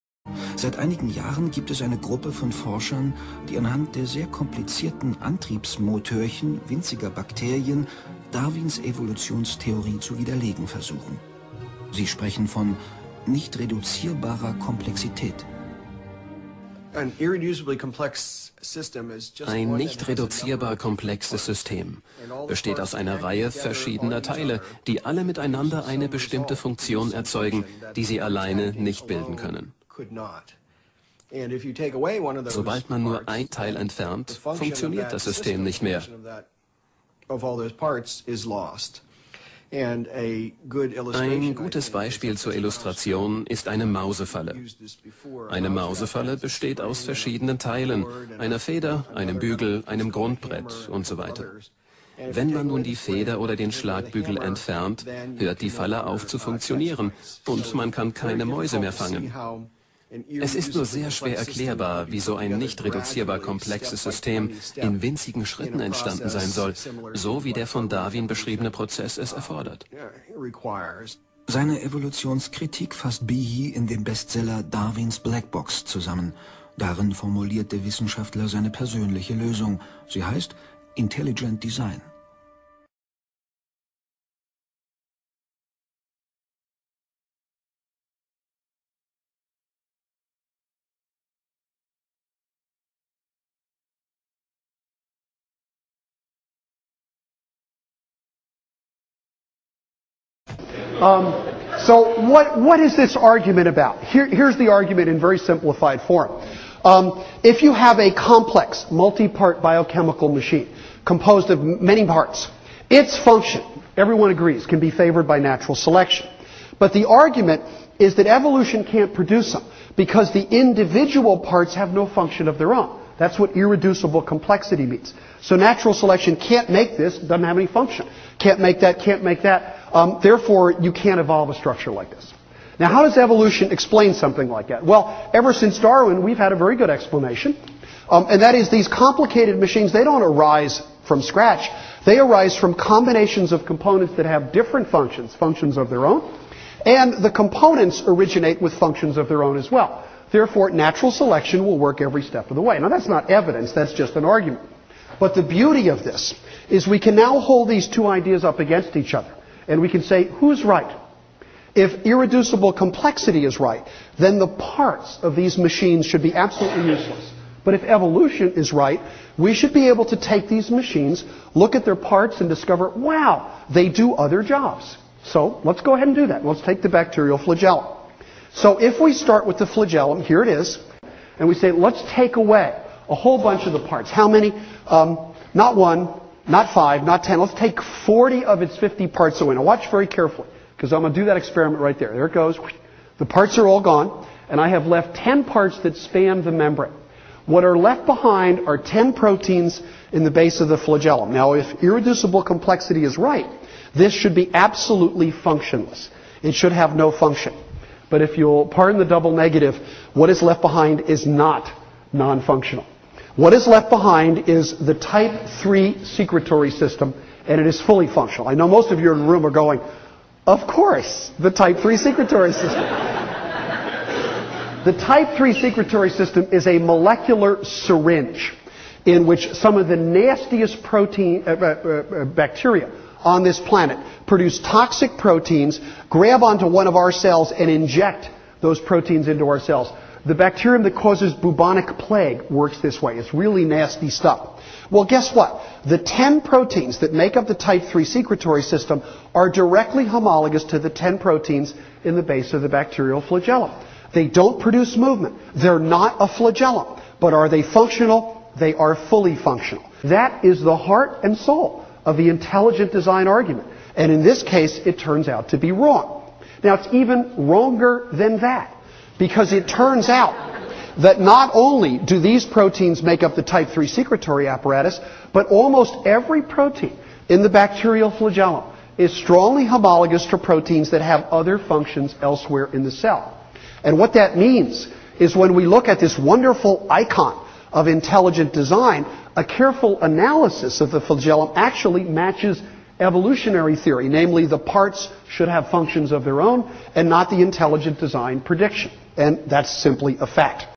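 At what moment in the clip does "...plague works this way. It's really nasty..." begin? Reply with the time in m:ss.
4:01.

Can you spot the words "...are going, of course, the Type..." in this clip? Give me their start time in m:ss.
3:39.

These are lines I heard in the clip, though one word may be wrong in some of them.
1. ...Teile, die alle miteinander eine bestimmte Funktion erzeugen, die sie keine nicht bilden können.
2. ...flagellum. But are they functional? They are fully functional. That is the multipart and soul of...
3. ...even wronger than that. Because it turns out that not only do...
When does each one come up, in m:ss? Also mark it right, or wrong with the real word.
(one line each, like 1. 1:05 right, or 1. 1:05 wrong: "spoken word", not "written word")
1. 0:24 wrong: "alleine", not "keine"
2. 4:16 wrong: "heart", not "multipart"
3. 4:26 right.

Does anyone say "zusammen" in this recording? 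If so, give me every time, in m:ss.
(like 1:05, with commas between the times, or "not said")
1:15.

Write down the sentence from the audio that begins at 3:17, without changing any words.
What are left behind are 10 proteins in the base of the flagellum.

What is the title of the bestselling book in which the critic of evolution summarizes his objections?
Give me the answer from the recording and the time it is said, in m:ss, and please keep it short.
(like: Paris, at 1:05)
Darwins Black Box, at 1:14.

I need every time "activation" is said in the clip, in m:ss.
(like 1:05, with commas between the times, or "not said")
not said.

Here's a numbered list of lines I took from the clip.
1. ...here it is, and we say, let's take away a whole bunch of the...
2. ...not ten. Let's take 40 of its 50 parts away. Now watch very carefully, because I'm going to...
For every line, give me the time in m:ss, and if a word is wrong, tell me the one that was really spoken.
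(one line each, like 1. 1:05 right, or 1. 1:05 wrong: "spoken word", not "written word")
1. 3:00 right
2. 3:07 right.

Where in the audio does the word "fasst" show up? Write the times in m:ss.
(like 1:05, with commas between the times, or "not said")
1:12.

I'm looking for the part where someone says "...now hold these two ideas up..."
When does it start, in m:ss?
2:37.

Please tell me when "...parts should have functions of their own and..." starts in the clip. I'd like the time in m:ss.
4:54.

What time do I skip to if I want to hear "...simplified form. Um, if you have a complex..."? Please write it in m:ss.
1:45.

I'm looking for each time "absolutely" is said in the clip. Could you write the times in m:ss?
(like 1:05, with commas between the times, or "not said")
2:46, 3:24.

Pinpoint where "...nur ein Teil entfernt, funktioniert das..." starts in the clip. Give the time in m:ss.
0:33.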